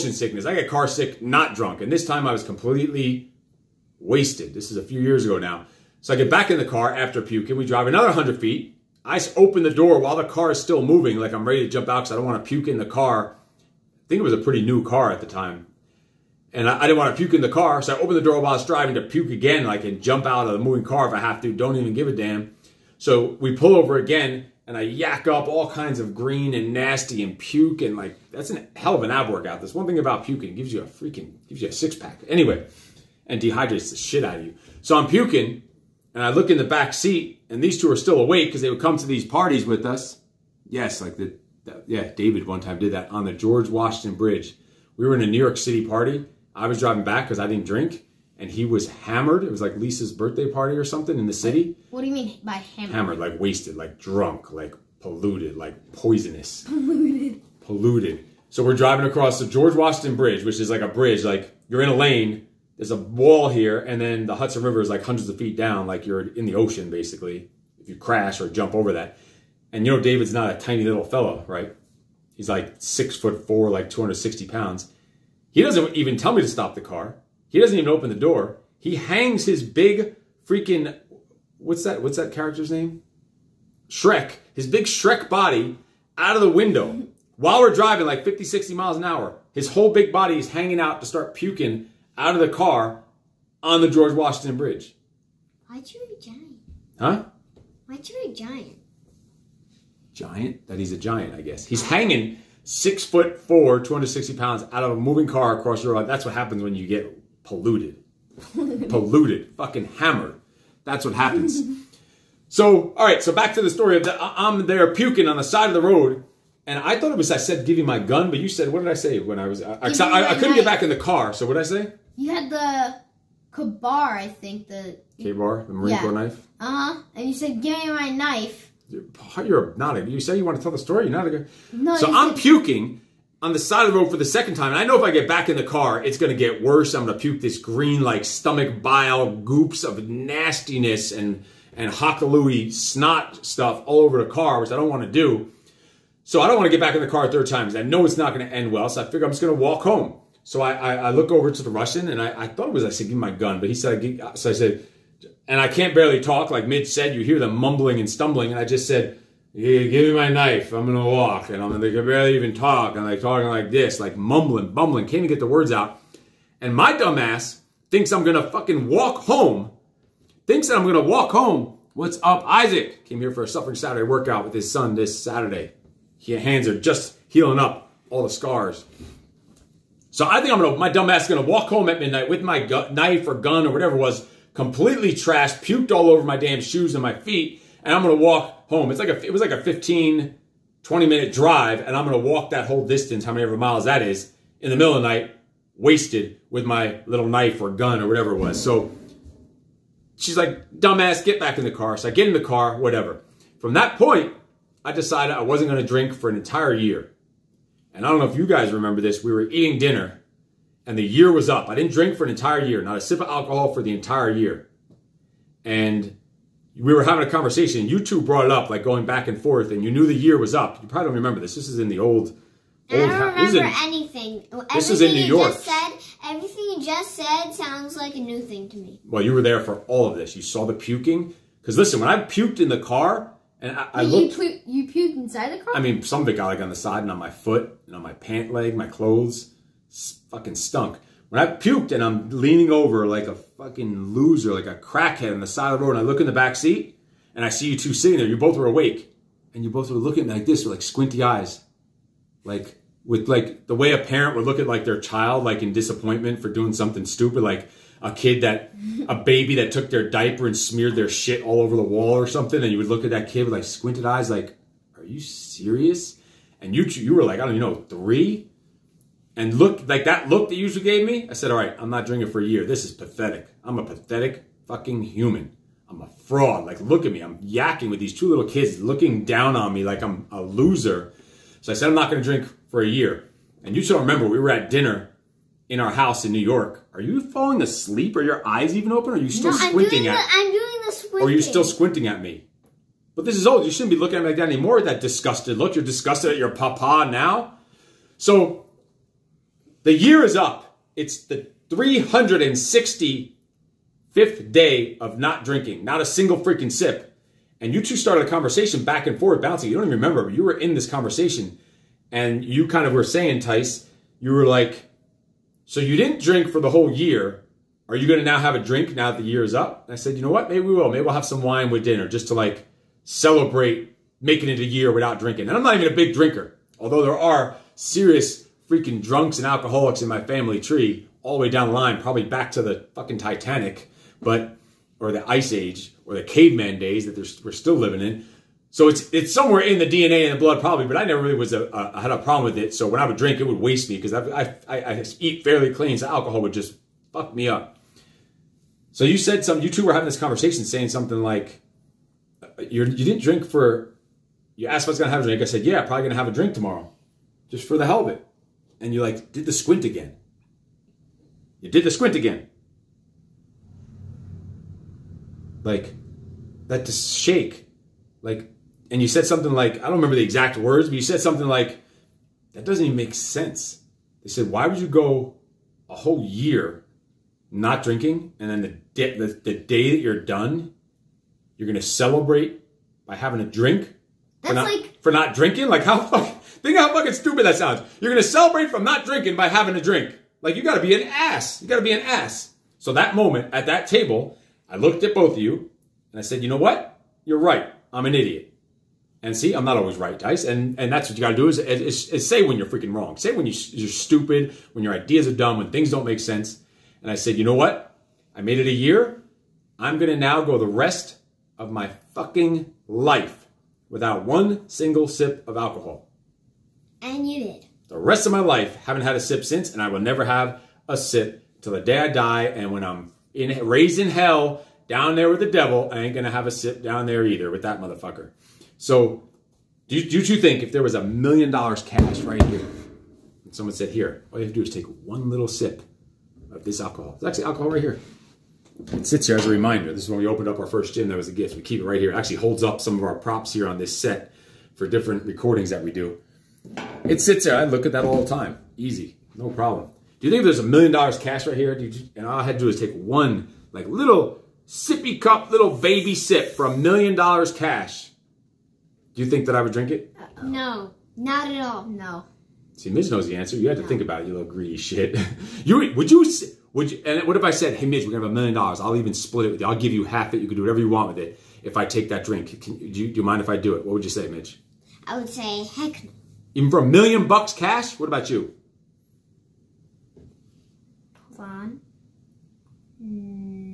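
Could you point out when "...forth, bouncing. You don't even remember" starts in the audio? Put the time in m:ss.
5:09.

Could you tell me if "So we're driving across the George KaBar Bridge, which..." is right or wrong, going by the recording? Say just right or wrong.
wrong.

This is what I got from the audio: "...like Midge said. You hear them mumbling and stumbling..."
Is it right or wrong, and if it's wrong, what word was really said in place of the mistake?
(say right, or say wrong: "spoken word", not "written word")
right.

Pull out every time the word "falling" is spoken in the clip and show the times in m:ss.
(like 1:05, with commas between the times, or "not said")
4:47.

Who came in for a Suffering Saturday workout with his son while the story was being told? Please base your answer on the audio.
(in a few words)
Isaac.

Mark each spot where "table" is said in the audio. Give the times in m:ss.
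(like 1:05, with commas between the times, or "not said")
6:33.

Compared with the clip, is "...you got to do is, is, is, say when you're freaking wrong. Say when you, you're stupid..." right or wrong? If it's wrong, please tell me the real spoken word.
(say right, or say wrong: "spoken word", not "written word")
right.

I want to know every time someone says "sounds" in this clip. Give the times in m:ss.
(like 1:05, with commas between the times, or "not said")
3:47, 6:27.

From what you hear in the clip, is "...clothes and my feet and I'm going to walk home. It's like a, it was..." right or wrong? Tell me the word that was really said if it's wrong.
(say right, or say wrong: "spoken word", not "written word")
wrong: "shoes", not "clothes".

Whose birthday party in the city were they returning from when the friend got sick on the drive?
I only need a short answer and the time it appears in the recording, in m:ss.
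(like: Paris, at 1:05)
Lisa's, at 0:49.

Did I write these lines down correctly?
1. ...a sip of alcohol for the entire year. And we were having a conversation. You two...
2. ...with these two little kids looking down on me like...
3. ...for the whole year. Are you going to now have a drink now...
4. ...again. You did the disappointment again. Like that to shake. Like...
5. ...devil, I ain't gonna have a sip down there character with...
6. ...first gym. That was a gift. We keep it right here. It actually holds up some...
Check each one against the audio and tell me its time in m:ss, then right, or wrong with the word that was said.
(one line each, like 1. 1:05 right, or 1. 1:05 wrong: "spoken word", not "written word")
1. 3:32 right
2. 4:37 right
3. 5:16 right
4. 5:59 wrong: "squint", not "disappointment"
5. 7:05 wrong: "either", not "character"
6. 7:20 right.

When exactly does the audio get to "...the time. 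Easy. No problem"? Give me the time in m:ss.
7:28.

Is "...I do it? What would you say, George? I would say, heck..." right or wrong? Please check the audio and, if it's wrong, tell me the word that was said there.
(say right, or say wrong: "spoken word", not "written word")
wrong: "Midge", not "George".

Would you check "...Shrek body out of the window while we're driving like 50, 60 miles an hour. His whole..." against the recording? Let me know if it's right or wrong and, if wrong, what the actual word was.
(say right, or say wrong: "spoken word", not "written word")
right.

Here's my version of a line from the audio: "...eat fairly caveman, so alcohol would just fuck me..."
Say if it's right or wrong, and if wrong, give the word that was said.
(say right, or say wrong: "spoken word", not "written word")
wrong: "clean", not "caveman".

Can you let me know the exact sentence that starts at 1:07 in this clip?
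If you crash or jump over that, and you know David's not a tiny little fellow, right?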